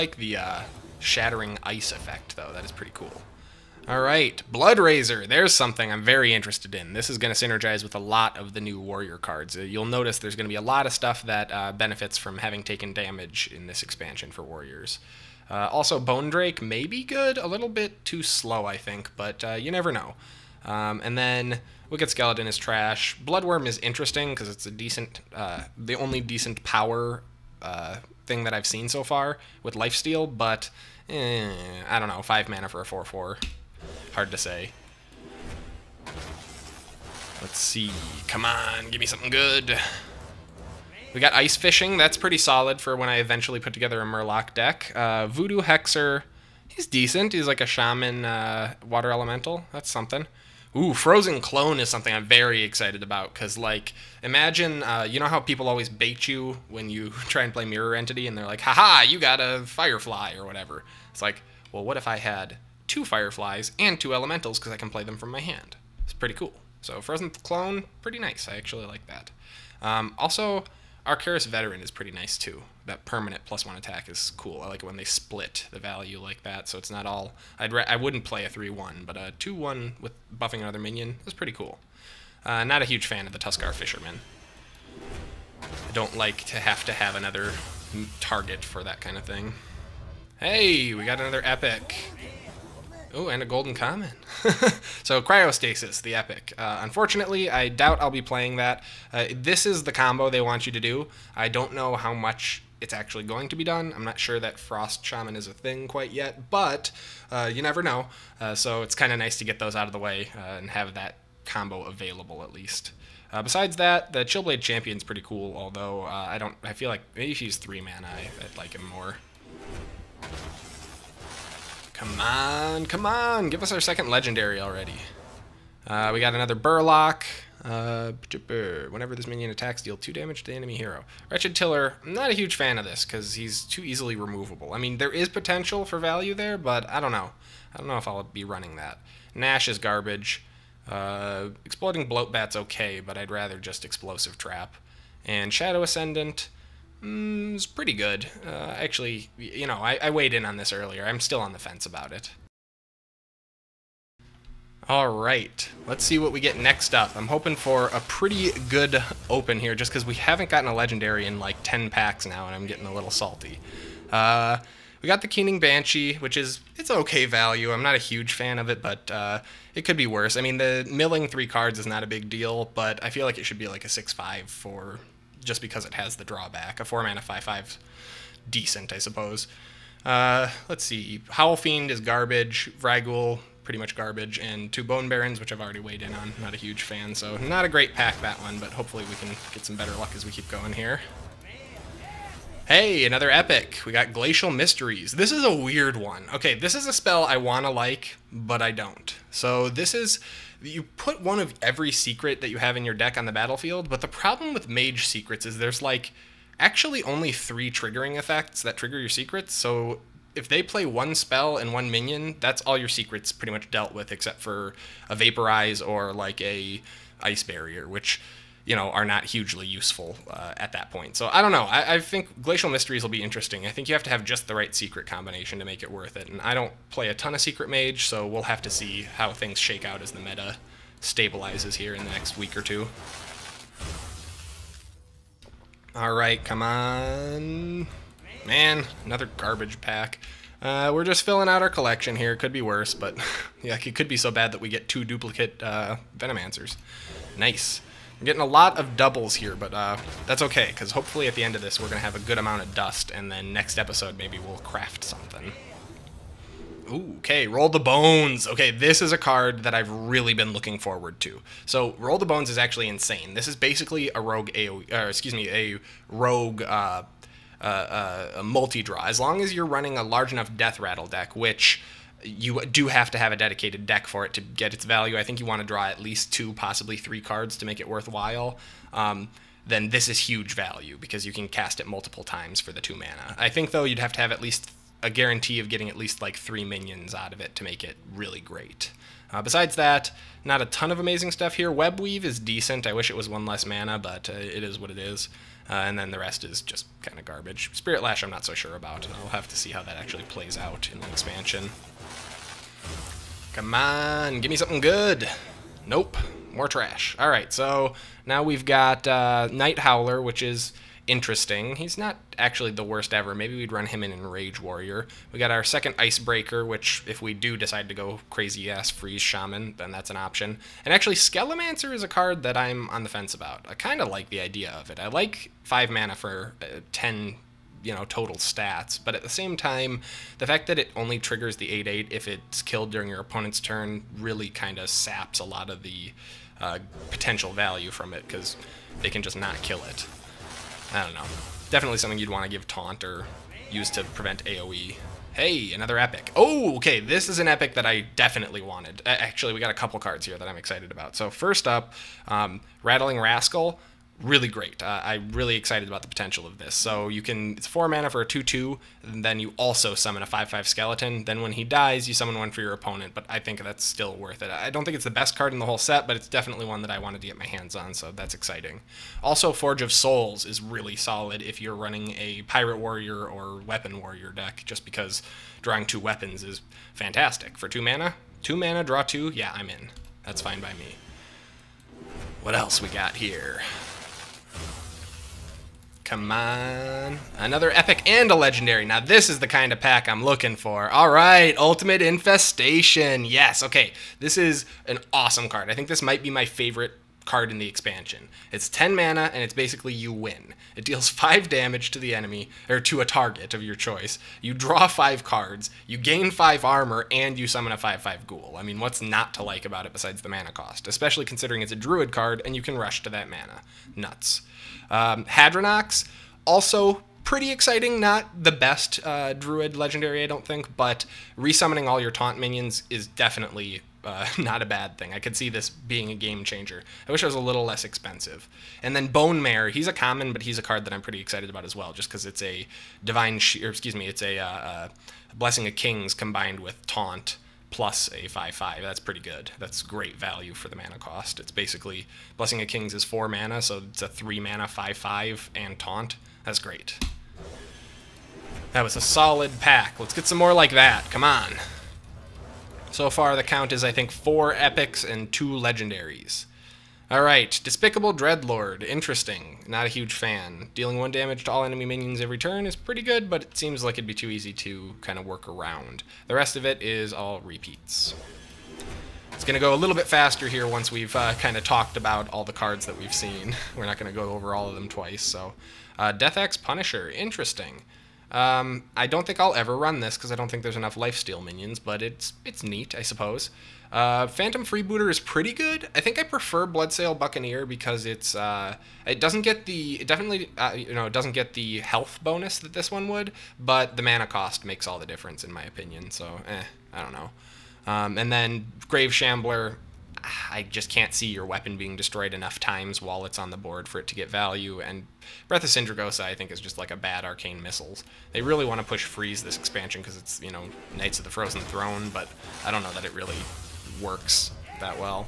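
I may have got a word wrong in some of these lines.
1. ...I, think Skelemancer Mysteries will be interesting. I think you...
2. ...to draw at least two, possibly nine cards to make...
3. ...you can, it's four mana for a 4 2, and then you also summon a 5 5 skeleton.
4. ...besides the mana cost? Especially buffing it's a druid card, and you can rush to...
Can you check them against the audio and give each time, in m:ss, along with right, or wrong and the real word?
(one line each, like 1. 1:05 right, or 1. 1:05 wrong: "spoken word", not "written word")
1. 3:41 wrong: "Glacial", not "Skelemancer"
2. 4:35 wrong: "three", not "nine"
3. 5:57 wrong: "2", not "4"
4. 6:49 wrong: "considering", not "buffing".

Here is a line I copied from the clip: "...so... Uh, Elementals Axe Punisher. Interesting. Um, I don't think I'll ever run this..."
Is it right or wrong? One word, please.
wrong.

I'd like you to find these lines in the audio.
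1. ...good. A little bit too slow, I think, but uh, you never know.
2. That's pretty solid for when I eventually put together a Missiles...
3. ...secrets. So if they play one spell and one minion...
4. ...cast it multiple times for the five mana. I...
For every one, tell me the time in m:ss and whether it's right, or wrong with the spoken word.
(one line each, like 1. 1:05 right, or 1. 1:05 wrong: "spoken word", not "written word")
1. 0:17 right
2. 0:41 wrong: "Murloc", not "Missiles"
3. 3:29 right
4. 4:41 wrong: "two", not "five".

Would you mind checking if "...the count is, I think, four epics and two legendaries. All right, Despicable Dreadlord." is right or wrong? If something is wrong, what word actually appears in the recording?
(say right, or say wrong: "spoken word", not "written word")
right.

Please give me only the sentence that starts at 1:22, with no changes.
Uh, not a huge fan of the Tuskarr Fisherman.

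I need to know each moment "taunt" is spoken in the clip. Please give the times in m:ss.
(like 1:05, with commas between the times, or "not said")
5:42, 7:02, 7:16, 7:25.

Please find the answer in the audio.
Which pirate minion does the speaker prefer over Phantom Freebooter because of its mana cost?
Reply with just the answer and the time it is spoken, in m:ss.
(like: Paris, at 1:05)
Bloodsail Buccaneer, at 8:06.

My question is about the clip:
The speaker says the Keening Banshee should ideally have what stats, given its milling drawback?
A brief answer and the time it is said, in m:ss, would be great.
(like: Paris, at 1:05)
6-5, at 2:53.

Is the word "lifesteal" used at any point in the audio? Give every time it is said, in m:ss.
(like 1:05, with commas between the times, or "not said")
0:29, 8:00.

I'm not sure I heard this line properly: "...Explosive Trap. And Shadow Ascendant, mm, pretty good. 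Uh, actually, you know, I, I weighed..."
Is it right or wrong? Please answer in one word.
right.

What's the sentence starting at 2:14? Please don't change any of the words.
I mean, there is potential for value there, but I don't know.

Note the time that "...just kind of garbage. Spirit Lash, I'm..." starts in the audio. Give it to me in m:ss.
4:56.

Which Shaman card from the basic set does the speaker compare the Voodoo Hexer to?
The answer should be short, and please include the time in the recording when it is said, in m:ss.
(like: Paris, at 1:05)
Water Elemental, at 0:48.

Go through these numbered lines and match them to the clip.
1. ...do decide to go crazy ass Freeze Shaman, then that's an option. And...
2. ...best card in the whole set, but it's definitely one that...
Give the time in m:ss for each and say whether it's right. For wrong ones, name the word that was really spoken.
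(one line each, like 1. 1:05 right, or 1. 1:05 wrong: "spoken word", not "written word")
1. 5:17 right
2. 6:05 right.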